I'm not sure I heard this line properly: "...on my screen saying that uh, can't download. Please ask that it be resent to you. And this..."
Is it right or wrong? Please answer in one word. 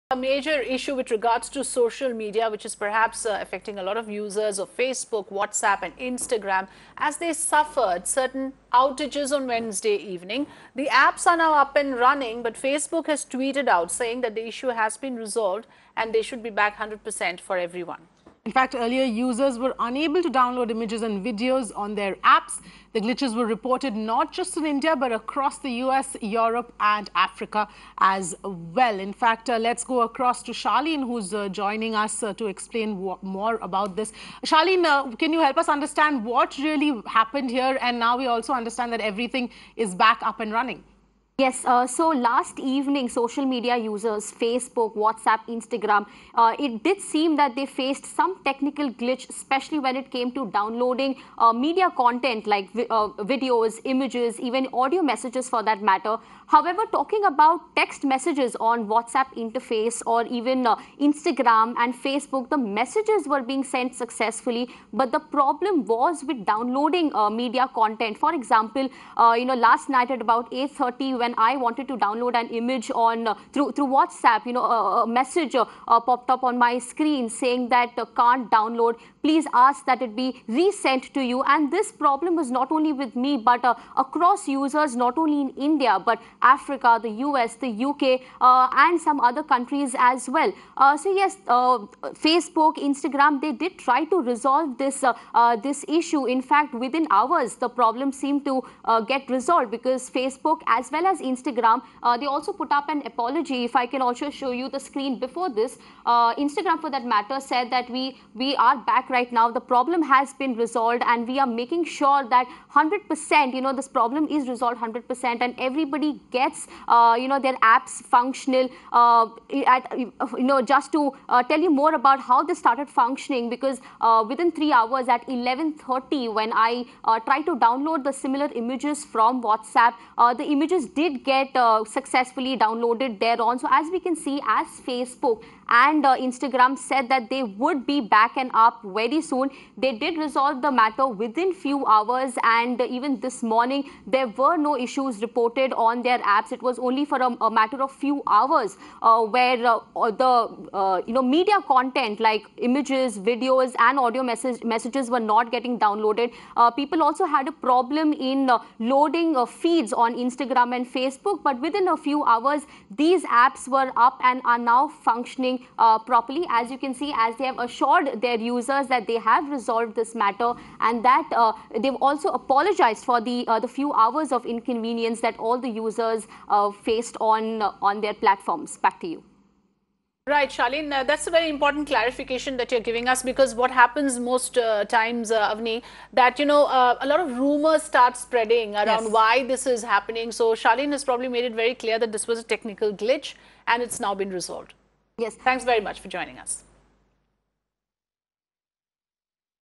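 right.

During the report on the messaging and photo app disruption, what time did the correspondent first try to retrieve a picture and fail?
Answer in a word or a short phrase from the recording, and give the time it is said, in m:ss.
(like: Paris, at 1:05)
8.30, at 1:10.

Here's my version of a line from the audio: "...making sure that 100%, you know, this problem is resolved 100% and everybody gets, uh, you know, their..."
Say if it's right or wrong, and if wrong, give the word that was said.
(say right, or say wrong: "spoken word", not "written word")
right.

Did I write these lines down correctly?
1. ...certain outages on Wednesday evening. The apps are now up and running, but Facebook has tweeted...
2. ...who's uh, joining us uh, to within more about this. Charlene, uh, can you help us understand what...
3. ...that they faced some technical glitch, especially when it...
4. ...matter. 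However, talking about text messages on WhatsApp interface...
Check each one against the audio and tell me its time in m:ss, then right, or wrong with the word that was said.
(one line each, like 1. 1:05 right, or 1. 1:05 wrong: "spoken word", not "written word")
1. 0:08 right
2. 0:31 wrong: "explain", not "within"
3. 0:47 right
4. 0:55 right.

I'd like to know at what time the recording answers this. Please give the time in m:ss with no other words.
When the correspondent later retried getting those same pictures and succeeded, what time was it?
2:05.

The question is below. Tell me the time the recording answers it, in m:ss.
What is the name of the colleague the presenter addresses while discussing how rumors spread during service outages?
3:05.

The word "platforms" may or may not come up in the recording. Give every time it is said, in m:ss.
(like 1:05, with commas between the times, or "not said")
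2:58.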